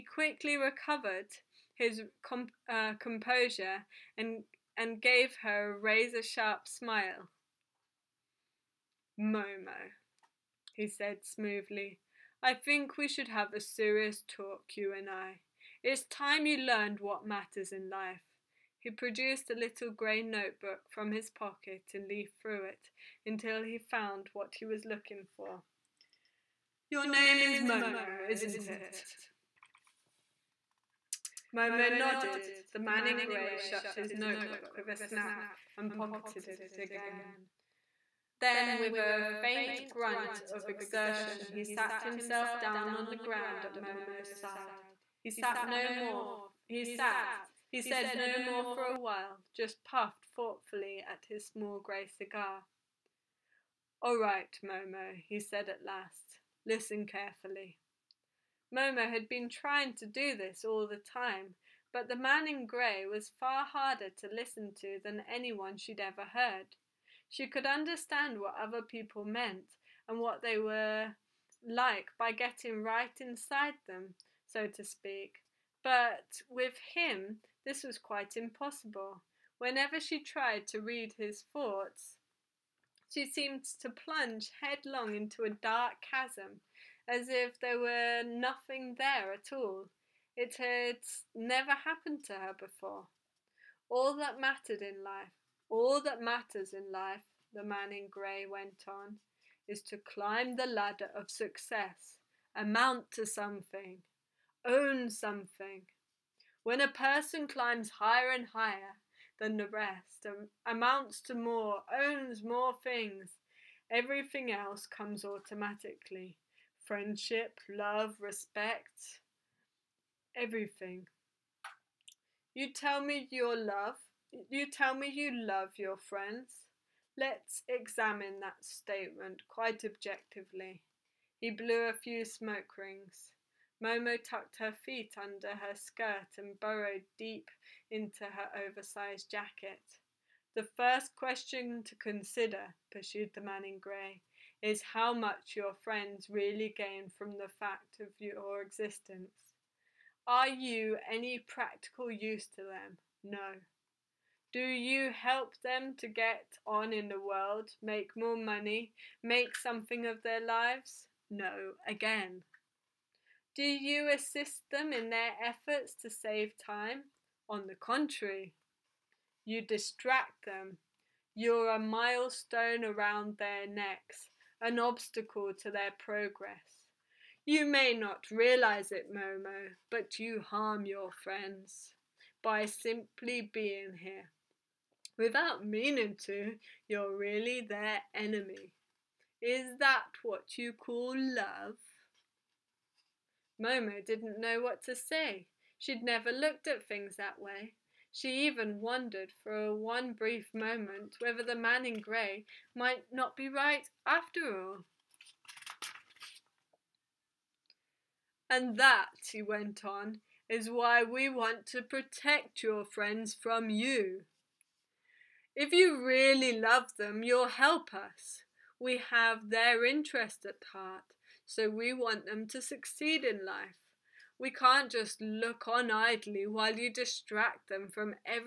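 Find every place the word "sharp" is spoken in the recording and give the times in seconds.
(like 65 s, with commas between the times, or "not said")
6 s.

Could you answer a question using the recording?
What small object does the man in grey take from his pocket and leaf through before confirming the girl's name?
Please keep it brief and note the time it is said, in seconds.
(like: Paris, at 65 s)
Grey notebook, at 19 s.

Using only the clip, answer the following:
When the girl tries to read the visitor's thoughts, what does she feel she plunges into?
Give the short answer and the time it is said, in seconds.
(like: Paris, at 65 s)
A dark chasm, at 85 s.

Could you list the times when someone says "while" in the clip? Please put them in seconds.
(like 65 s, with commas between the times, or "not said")
48 s, 226 s.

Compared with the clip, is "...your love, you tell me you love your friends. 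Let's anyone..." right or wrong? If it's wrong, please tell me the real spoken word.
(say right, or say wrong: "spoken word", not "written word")
wrong: "examine", not "anyone".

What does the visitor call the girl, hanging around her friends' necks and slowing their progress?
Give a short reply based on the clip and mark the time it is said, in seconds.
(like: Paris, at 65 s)
A milestone, at 171 s.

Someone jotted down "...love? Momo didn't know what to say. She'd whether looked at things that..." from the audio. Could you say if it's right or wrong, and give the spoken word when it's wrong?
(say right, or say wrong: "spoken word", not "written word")
wrong: "never", not "whether".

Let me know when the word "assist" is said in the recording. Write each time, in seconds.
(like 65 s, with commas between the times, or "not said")
164 s.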